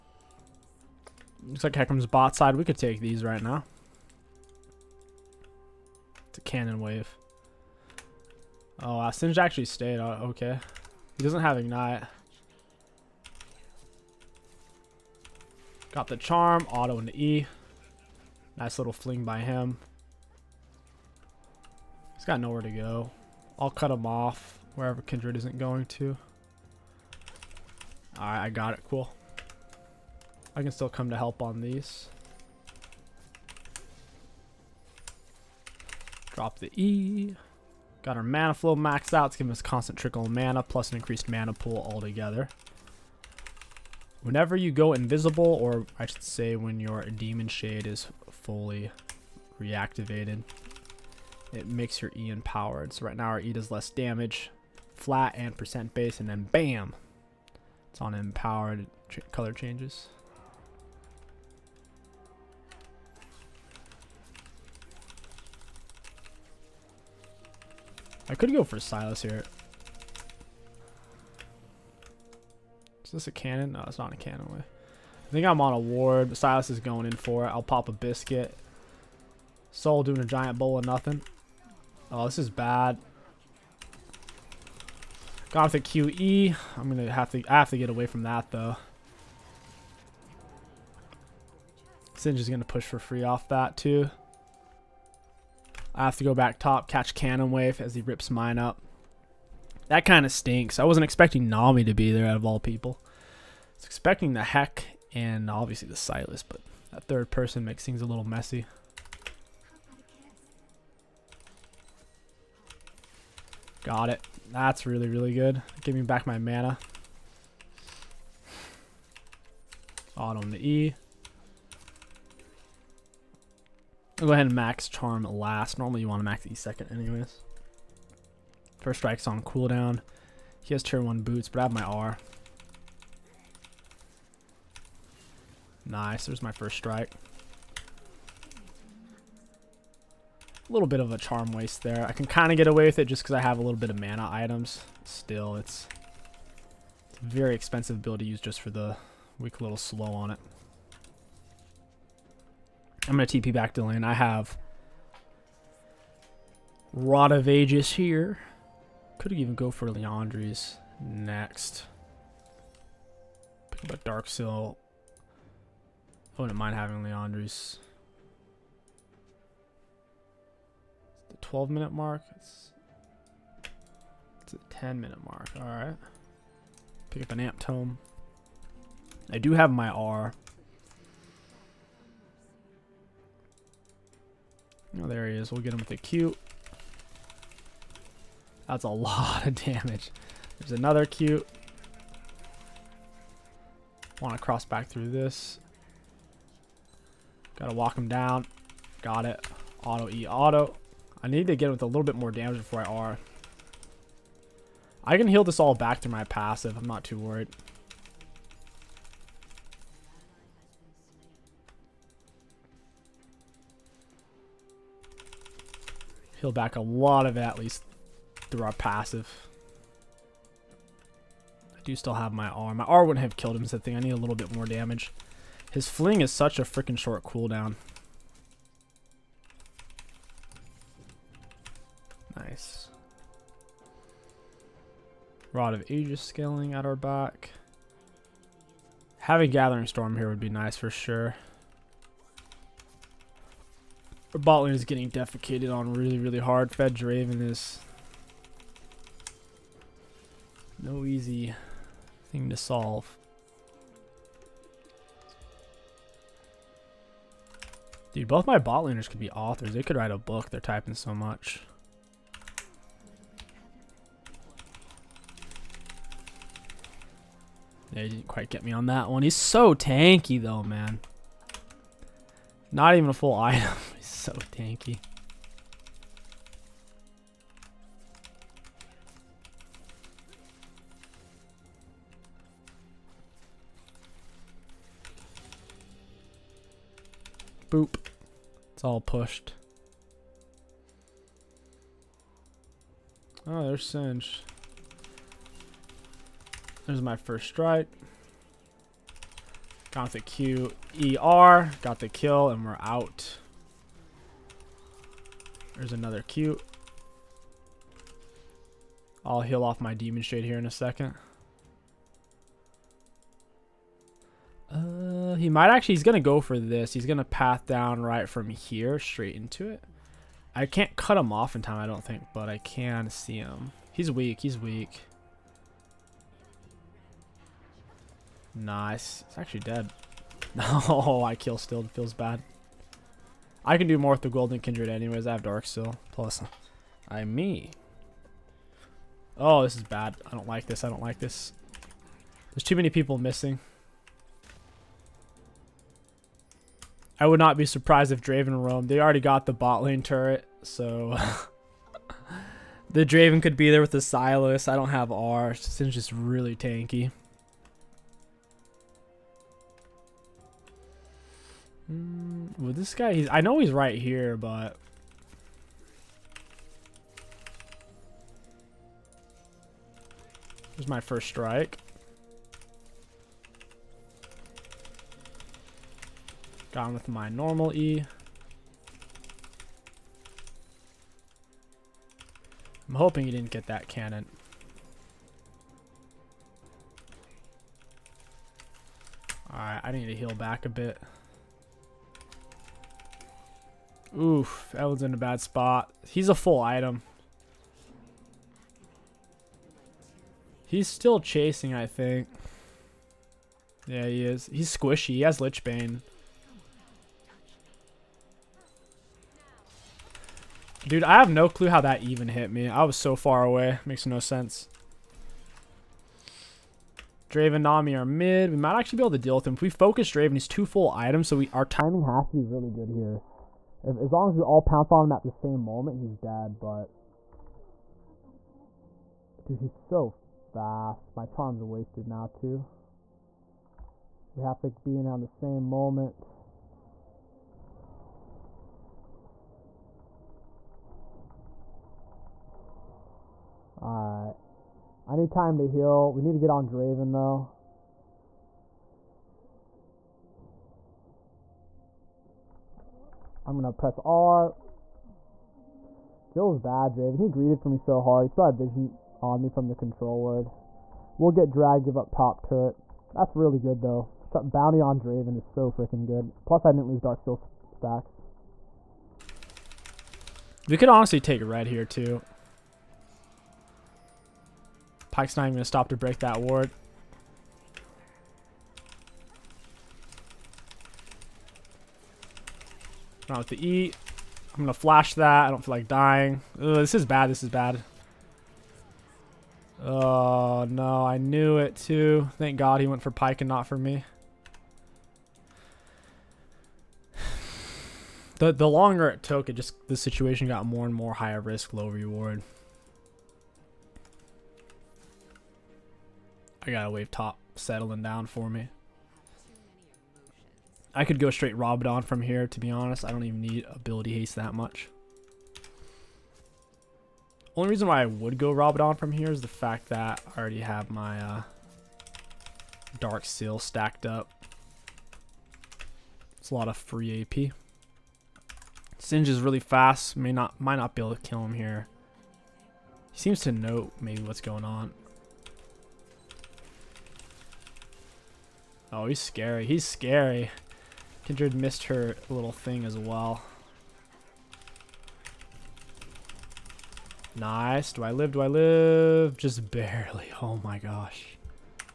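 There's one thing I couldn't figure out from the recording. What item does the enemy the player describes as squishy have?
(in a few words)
Lich Bane.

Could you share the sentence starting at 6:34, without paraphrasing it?
Oof, Ellen's in a bad spot.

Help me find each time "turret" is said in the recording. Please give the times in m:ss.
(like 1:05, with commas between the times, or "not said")
5:50, 7:42.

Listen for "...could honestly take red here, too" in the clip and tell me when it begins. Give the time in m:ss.
7:50.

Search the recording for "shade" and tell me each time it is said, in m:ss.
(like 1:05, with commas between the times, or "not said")
0:47, 5:10.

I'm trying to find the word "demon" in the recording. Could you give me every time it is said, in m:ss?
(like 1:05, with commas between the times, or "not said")
0:47, 5:09.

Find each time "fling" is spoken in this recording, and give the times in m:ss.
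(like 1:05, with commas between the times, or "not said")
0:18, 3:45.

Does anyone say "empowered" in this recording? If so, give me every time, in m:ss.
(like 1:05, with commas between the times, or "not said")
0:52, 0:58.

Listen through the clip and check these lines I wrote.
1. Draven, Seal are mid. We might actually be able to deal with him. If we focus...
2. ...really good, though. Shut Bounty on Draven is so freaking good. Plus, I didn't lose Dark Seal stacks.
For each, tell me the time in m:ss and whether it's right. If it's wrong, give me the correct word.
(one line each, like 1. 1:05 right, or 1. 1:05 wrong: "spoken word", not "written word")
1. 6:57 wrong: "Nami", not "Seal"
2. 7:43 right.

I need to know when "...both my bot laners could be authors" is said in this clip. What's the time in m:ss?
4:18.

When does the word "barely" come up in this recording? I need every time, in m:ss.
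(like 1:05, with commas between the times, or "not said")
9:09.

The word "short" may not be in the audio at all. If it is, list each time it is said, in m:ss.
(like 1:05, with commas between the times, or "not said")
3:46.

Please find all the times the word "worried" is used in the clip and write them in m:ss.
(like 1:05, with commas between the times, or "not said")
3:27.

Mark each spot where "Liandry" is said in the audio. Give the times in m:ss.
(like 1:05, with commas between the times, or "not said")
2:39, 2:47.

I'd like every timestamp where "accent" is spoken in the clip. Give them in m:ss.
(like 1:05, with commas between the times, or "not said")
not said.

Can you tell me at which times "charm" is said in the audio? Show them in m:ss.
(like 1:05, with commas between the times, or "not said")
0:16, 2:04, 2:21, 7:11.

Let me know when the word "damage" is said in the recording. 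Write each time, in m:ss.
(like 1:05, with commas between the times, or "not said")
0:53, 3:09, 3:22, 3:44.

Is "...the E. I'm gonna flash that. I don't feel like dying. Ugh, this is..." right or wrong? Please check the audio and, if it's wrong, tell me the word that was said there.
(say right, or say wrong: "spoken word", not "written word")
right.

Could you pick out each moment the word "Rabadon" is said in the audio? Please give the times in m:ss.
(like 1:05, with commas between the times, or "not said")
8:31, 8:38.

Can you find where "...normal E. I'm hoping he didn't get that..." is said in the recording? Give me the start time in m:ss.
6:17.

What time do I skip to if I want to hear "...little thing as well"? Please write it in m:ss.
9:02.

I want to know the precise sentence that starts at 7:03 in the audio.
If, as long as we all pounce on him at the same moment, he's dead, but...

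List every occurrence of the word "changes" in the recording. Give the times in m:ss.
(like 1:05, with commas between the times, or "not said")
0:59.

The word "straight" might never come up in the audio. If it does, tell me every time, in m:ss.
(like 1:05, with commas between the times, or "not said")
5:18, 8:31.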